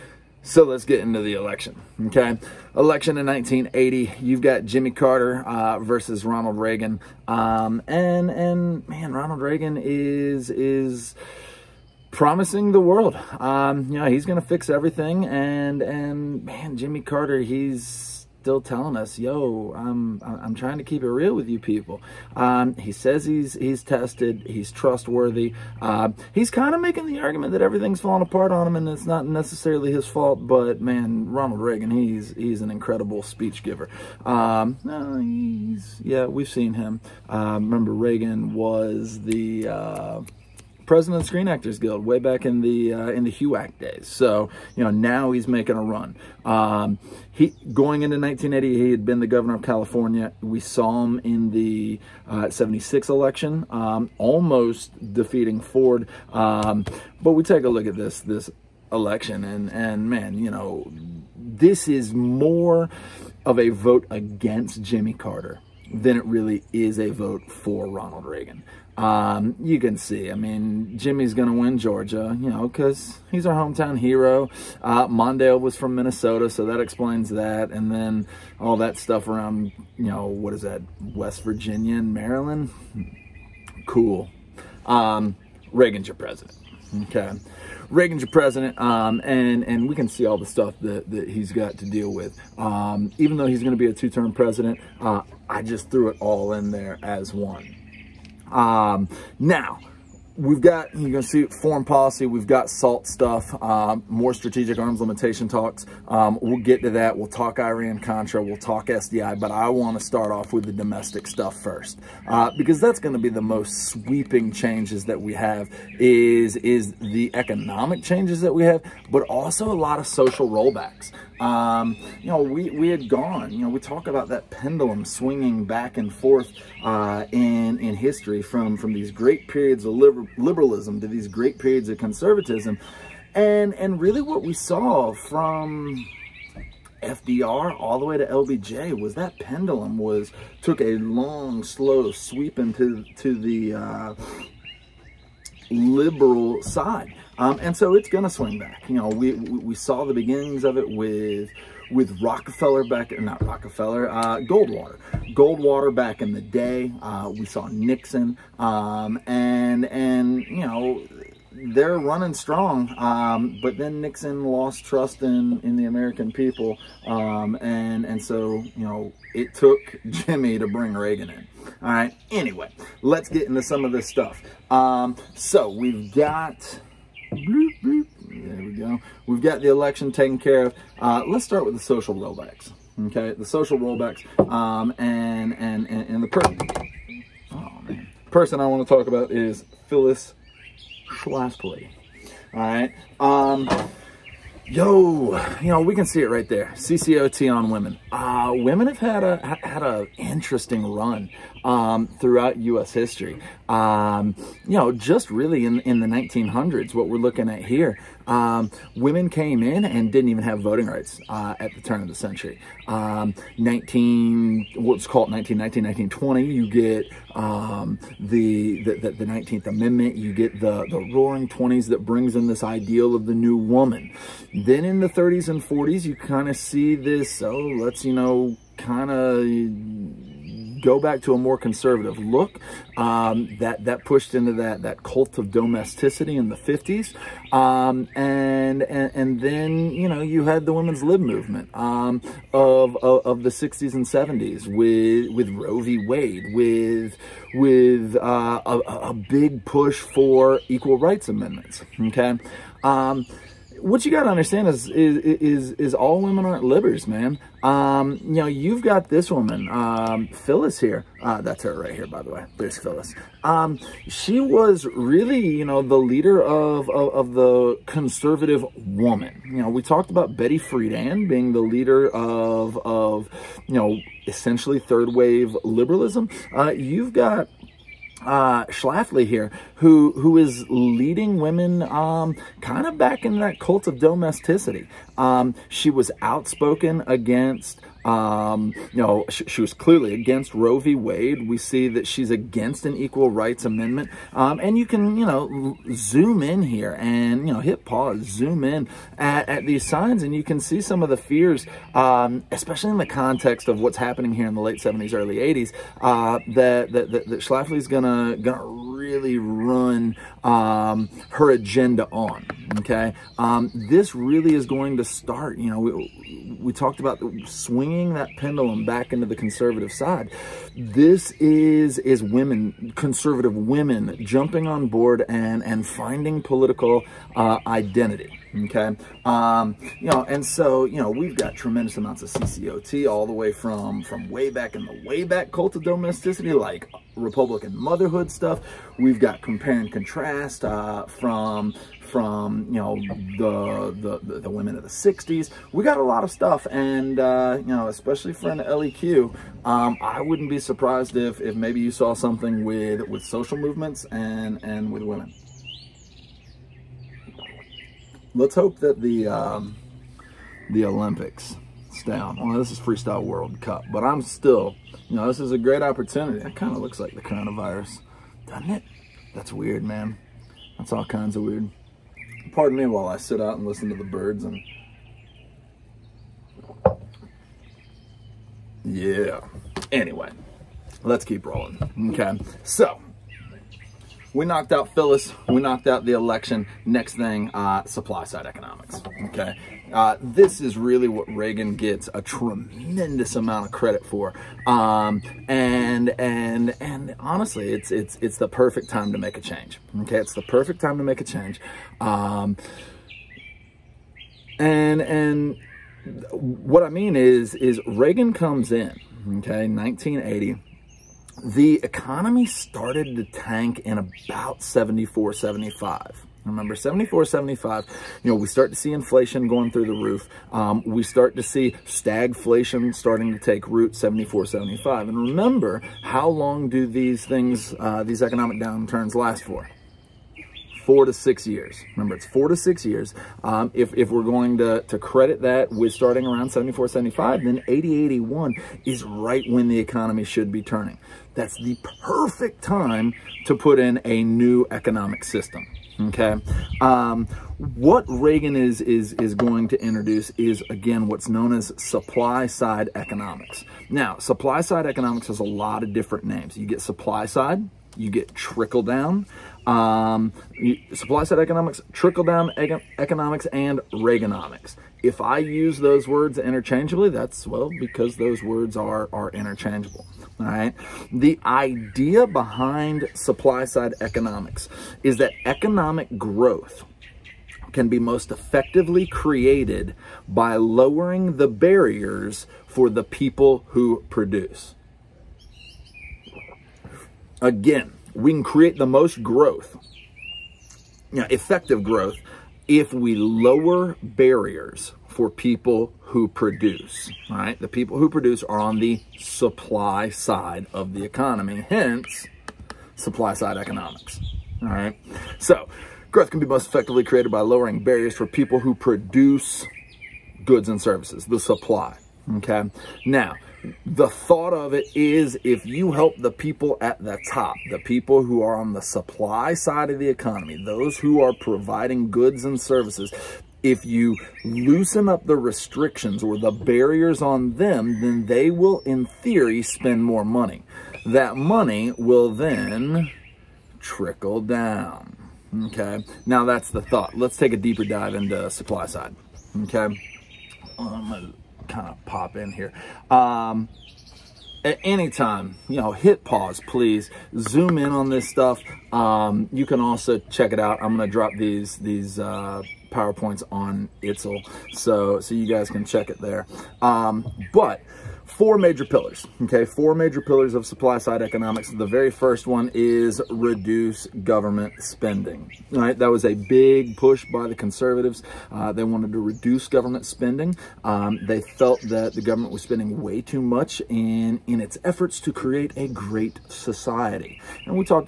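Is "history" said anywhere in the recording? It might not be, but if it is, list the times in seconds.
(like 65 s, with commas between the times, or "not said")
127 s, 202 s.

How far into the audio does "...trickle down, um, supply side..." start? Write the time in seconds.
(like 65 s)
458 s.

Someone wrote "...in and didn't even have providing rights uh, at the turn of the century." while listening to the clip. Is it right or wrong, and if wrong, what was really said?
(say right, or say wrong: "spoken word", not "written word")
wrong: "voting", not "providing".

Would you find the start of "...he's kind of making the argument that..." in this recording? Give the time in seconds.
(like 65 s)
26 s.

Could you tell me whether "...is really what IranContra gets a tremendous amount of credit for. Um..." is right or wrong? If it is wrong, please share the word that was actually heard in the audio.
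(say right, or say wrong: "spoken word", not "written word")
wrong: "Reagan", not "IranContra".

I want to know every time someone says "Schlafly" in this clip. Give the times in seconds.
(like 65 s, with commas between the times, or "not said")
191 s, 278 s, 307 s.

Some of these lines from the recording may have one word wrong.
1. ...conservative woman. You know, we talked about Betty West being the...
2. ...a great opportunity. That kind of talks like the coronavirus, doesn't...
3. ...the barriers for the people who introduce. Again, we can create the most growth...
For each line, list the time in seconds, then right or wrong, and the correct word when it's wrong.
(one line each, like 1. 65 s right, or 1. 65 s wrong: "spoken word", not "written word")
1. 267 s wrong: "Friedan", not "West"
2. 365 s wrong: "looks", not "talks"
3. 481 s wrong: "produce", not "introduce".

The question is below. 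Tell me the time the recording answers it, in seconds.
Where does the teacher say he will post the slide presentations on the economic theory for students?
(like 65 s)
554 s.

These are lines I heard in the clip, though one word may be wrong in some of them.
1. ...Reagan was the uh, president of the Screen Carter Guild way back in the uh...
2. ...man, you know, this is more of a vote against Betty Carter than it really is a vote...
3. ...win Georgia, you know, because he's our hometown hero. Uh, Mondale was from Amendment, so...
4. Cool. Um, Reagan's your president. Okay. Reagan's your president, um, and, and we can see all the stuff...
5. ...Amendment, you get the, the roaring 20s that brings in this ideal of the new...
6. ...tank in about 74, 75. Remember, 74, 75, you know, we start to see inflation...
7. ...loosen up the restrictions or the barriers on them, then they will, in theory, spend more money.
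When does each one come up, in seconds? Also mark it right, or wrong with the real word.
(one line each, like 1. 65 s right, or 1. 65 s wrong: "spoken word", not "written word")
1. 37 s wrong: "Actors", not "Carter"
2. 60 s wrong: "Jimmy", not "Betty"
3. 71 s wrong: "Minnesota", not "Amendment"
4. 83 s right
5. 219 s right
6. 413 s right
7. 524 s right.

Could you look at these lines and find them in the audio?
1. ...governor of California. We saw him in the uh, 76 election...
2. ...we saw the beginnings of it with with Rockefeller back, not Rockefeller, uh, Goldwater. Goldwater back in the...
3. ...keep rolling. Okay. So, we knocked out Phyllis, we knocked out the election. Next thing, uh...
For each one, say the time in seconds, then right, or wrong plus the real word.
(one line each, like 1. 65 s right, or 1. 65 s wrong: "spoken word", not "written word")
1. 49 s right
2. 149 s right
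3. 381 s right.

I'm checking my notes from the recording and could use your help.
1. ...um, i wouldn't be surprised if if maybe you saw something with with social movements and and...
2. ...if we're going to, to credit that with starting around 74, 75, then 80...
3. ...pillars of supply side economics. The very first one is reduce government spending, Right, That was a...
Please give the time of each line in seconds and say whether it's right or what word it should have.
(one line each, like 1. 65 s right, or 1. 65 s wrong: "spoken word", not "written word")
1. 349 s right
2. 433 s right
3. 560 s right.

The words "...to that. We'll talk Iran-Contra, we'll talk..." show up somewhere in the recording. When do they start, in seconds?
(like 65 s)
106 s.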